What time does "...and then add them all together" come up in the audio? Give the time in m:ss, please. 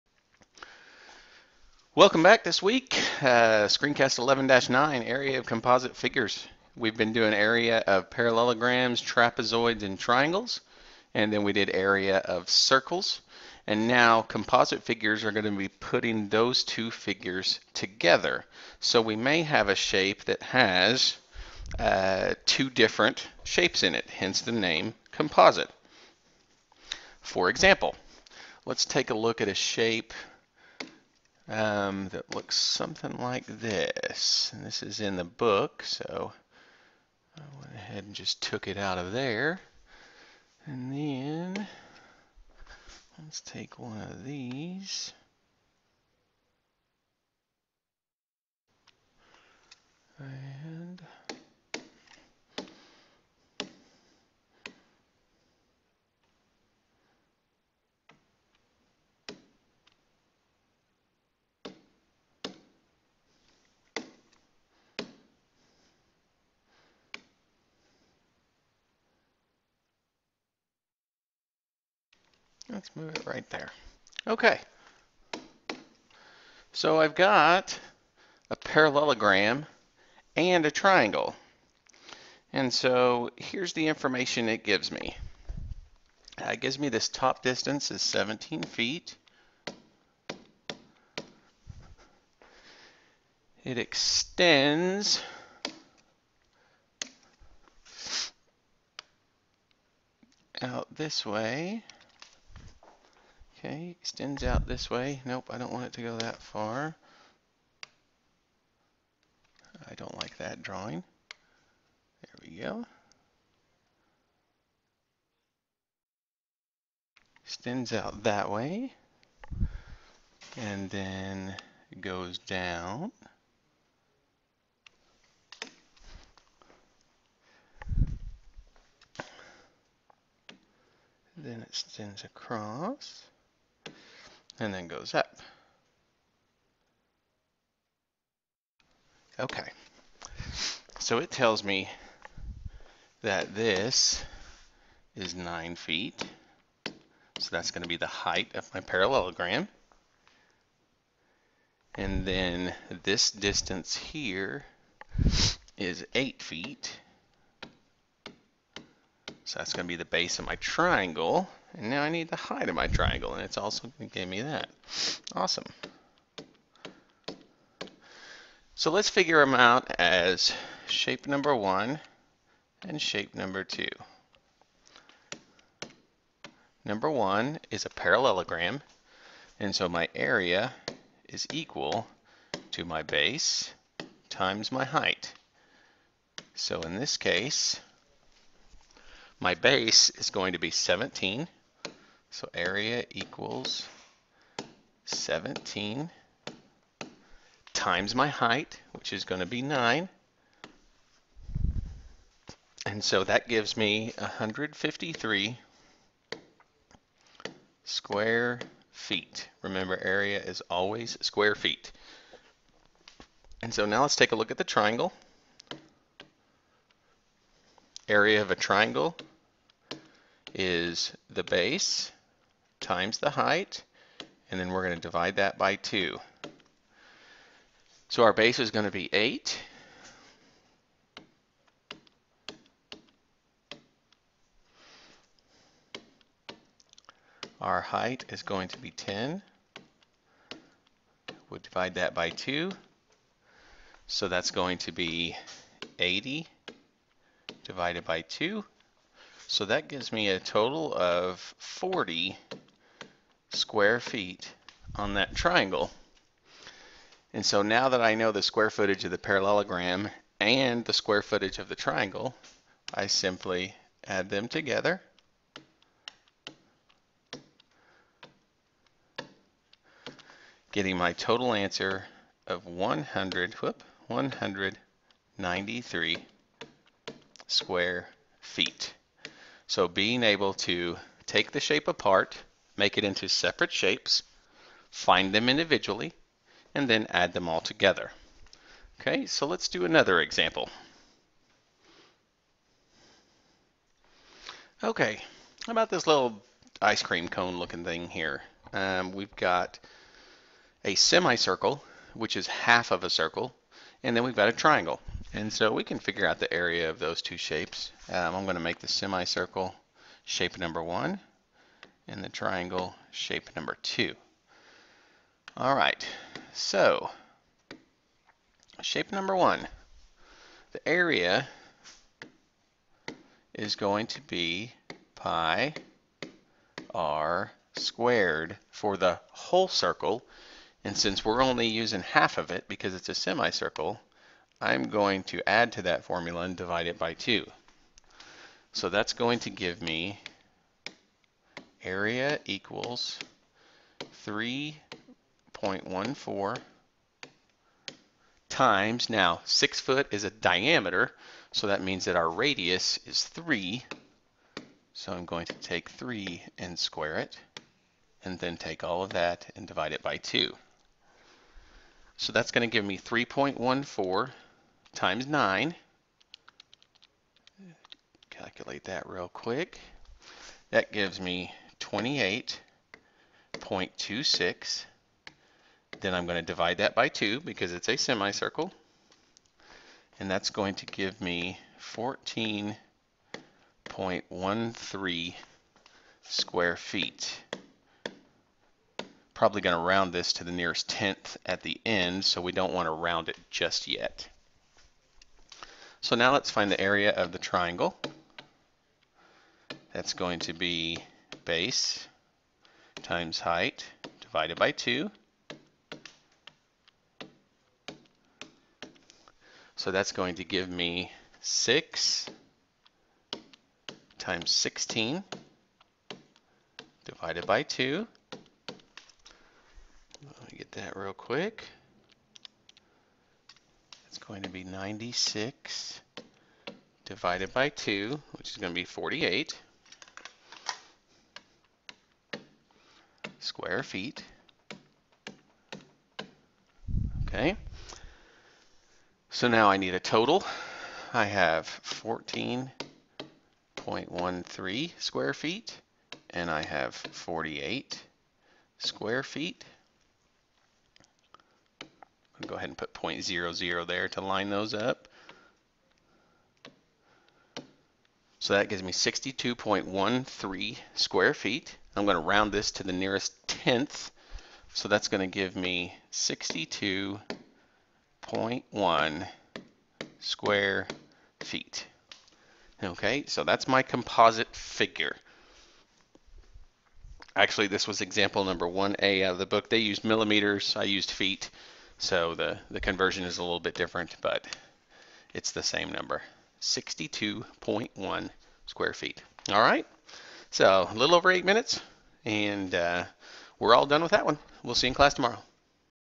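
4:46.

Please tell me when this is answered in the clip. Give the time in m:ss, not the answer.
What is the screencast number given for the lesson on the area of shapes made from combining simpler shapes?
0:04.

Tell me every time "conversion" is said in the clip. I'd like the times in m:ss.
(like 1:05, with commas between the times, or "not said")
8:02.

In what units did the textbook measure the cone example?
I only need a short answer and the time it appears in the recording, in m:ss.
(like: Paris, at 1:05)
Millimeters, at 8:00.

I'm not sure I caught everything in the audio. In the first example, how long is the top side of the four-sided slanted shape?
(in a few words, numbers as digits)
17 feet.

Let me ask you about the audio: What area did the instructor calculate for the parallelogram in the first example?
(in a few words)
153 square feet.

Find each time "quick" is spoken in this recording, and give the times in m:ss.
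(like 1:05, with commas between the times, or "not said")
6:09, 7:01.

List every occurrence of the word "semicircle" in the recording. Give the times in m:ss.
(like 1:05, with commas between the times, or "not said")
5:00, 5:08, 5:33, 6:17.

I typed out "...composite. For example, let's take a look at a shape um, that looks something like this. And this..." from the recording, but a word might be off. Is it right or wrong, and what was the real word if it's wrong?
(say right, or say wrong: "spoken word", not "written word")
right.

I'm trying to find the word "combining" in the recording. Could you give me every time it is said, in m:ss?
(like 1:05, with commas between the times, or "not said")
not said.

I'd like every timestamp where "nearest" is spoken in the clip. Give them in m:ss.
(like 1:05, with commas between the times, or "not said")
6:30, 7:42.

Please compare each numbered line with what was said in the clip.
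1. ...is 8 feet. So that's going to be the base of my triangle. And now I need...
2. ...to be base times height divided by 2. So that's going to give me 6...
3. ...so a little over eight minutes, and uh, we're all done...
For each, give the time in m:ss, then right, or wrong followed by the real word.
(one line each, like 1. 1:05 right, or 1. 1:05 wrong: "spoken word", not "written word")
1. 2:35 right
2. 6:40 right
3. 8:10 right.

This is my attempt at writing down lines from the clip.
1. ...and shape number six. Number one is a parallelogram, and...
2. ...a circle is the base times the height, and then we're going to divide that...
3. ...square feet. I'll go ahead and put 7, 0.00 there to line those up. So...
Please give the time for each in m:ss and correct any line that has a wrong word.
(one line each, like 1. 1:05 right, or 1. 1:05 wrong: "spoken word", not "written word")
1. 2:52 wrong: "two", not "six"
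2. 3:38 wrong: "triangle", not "circle"
3. 7:28 wrong: "0", not "7".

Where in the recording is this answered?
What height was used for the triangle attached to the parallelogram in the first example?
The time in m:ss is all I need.
3:58.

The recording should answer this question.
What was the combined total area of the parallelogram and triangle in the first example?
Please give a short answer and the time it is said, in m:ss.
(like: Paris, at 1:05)
193 square feet, at 4:34.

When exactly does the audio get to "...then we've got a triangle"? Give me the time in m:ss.
5:04.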